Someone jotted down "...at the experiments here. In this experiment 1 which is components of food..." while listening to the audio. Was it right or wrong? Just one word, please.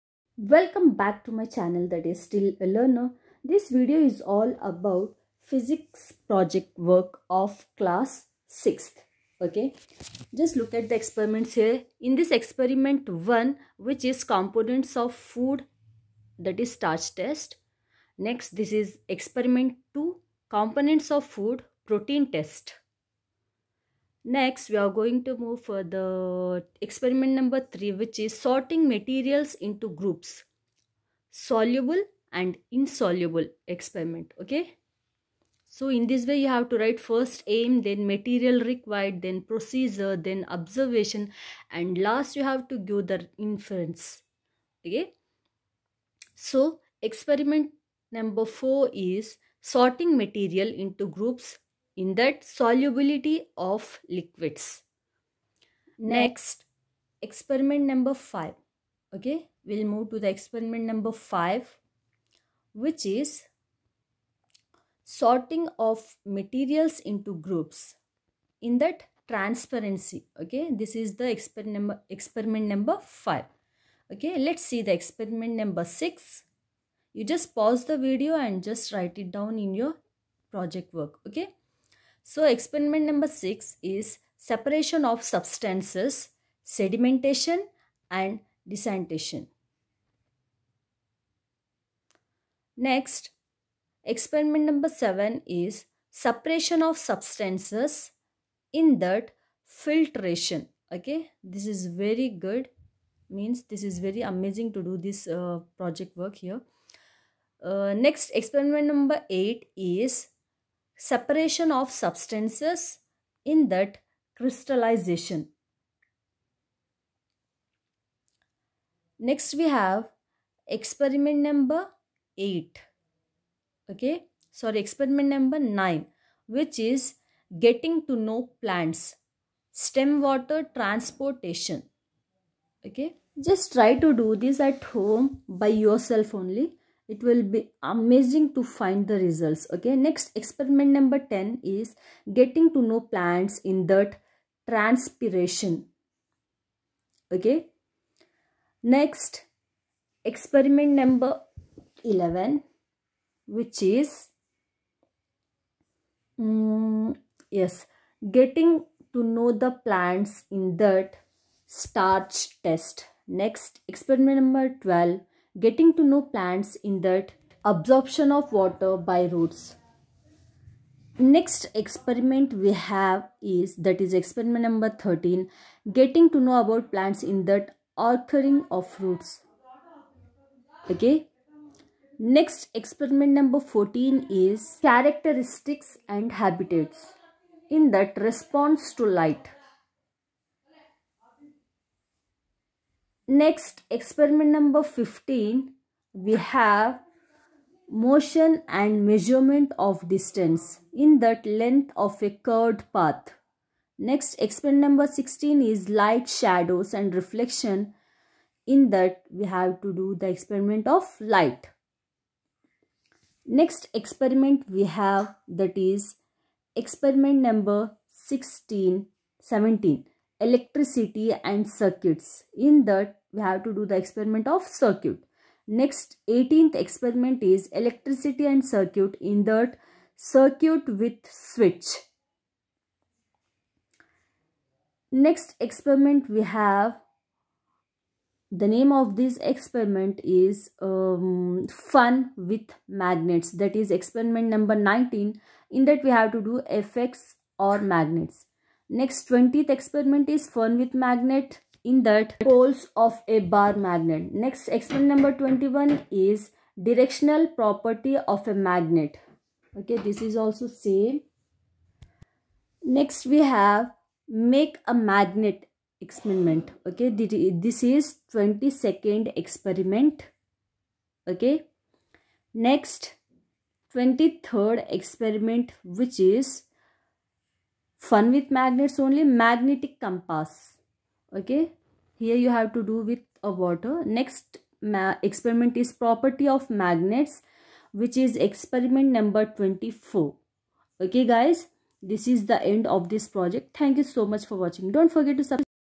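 right.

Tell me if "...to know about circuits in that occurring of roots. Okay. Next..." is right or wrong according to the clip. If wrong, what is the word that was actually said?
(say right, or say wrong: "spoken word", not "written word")
wrong: "plants", not "circuits".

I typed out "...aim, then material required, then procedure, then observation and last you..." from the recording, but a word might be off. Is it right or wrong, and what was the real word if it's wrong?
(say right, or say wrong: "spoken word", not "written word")
right.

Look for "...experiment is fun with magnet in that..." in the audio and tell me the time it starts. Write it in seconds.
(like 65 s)
249 s.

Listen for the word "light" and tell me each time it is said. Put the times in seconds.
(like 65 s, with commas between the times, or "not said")
189 s, 205 s, 211 s.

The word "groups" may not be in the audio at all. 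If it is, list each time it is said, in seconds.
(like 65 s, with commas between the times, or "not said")
29 s, 51 s, 67 s.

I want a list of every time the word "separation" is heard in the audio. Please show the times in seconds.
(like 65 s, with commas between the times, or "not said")
84 s, 96 s, 111 s.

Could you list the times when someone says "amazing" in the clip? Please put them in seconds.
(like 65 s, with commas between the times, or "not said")
104 s, 137 s.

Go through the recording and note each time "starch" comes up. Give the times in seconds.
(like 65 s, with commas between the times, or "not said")
16 s, 161 s.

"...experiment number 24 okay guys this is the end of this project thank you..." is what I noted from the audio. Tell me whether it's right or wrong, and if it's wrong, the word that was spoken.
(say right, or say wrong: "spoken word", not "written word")
right.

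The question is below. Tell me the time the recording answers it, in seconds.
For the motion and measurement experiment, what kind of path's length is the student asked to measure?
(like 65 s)
202 s.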